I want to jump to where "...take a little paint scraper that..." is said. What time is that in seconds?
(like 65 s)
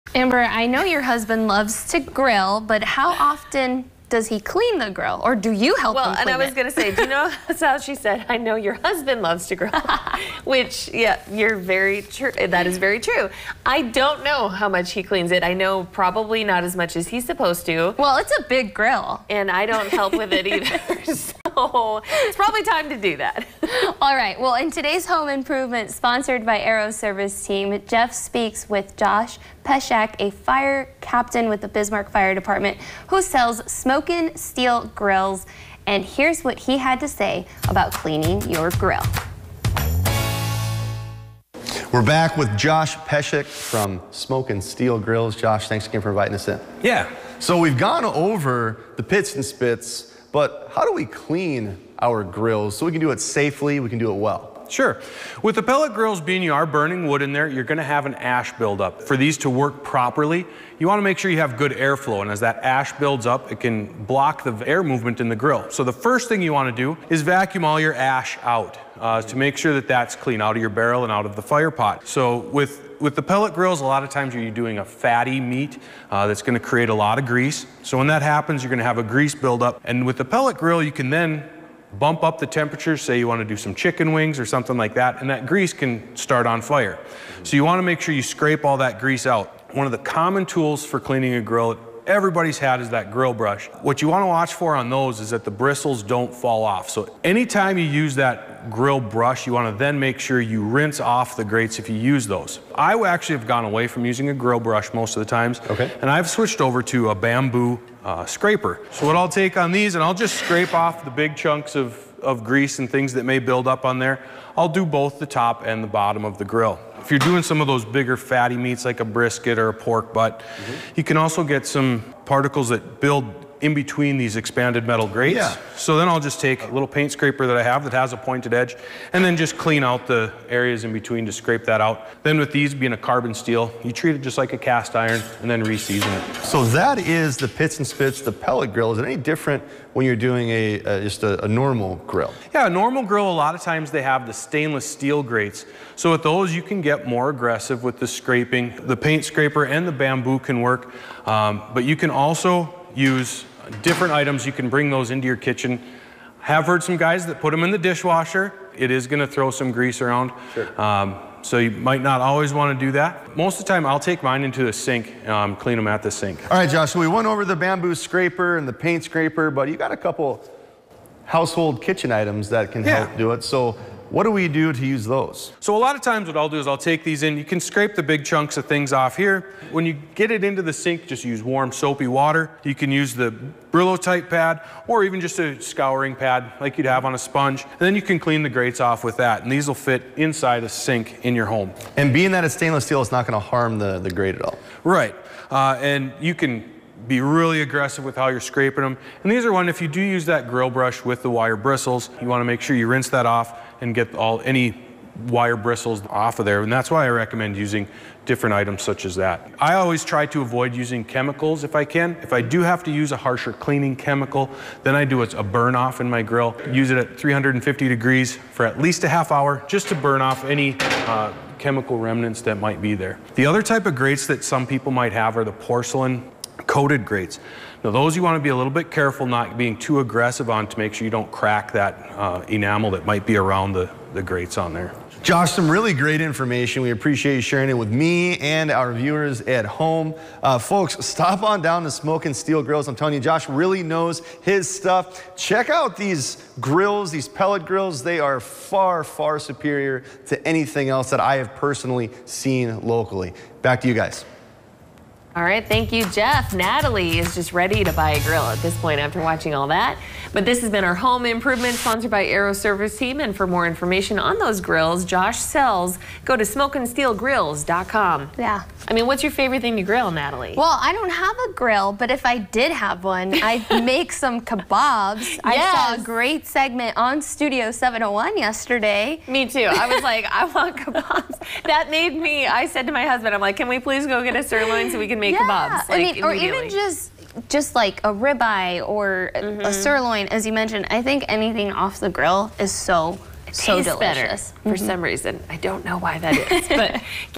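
126 s.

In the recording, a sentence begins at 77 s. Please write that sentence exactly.
So when that happens, you're going to have a grease buildup.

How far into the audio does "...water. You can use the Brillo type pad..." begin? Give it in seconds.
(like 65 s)
182 s.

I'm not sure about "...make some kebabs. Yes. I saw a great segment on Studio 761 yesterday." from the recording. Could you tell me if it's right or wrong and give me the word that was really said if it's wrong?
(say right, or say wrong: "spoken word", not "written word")
wrong: "701", not "761".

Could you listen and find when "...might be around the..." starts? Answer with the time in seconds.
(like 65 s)
233 s.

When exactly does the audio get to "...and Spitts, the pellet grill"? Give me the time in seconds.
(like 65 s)
137 s.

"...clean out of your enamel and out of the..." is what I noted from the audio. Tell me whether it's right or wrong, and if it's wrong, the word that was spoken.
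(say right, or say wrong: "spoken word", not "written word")
wrong: "barrel", not "enamel".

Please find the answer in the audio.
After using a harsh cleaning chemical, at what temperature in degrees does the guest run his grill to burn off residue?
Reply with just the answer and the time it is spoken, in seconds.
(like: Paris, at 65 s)
350, at 217 s.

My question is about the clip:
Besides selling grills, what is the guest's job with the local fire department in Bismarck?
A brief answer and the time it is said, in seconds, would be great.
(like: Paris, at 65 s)
Fire captain, at 30 s.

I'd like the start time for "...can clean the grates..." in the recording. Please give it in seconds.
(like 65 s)
188 s.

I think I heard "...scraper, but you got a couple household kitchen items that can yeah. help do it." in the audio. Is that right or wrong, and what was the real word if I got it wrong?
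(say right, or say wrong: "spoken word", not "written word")
right.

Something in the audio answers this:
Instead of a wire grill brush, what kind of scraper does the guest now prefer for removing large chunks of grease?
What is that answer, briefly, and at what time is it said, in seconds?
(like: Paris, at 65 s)
Bamboo scraper, at 107 s.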